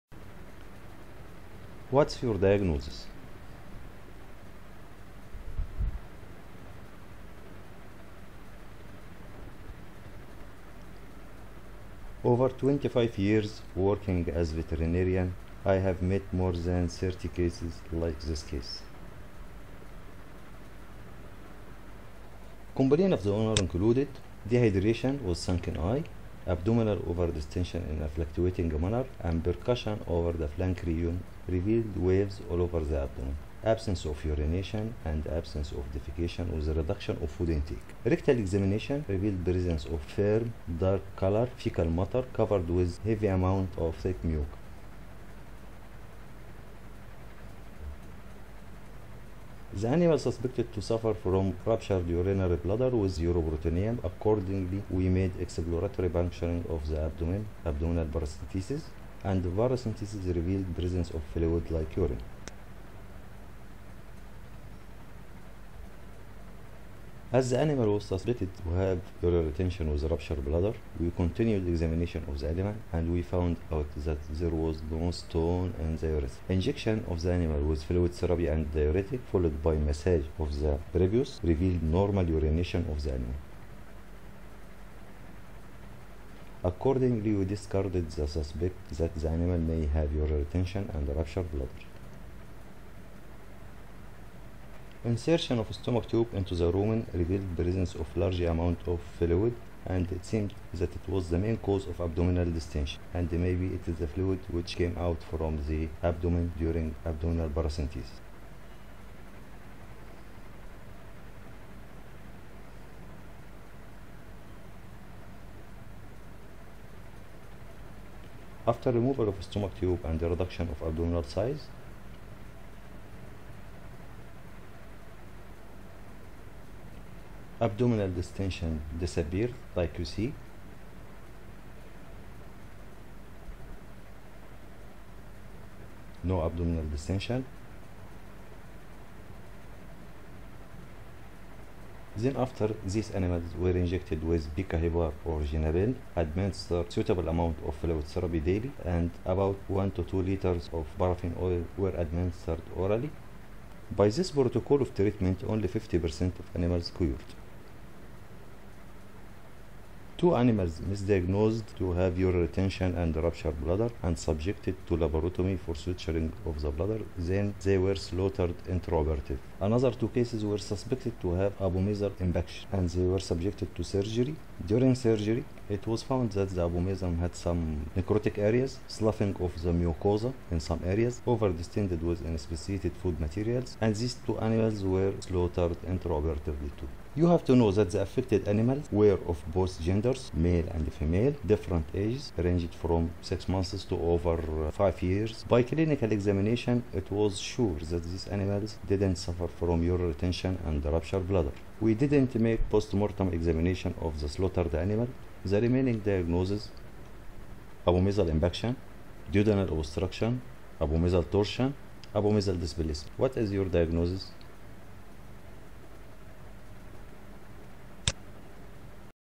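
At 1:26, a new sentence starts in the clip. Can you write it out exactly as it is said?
Accordingly, we discarded the suspect that the animal may have urinary retention and ruptured bladder.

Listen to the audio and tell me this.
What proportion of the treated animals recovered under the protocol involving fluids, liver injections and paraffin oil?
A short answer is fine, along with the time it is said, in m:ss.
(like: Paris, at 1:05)
50%, at 2:35.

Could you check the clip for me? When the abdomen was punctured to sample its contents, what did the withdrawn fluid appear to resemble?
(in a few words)
urine.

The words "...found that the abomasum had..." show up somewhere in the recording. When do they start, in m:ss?
2:56.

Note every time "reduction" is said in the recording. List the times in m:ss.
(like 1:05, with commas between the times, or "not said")
0:36, 2:00.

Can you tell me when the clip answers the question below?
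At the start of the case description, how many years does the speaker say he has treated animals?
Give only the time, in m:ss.
0:12.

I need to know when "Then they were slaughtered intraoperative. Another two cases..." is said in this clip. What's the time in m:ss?
2:47.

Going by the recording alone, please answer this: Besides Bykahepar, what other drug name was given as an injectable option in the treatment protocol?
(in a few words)
Genabil.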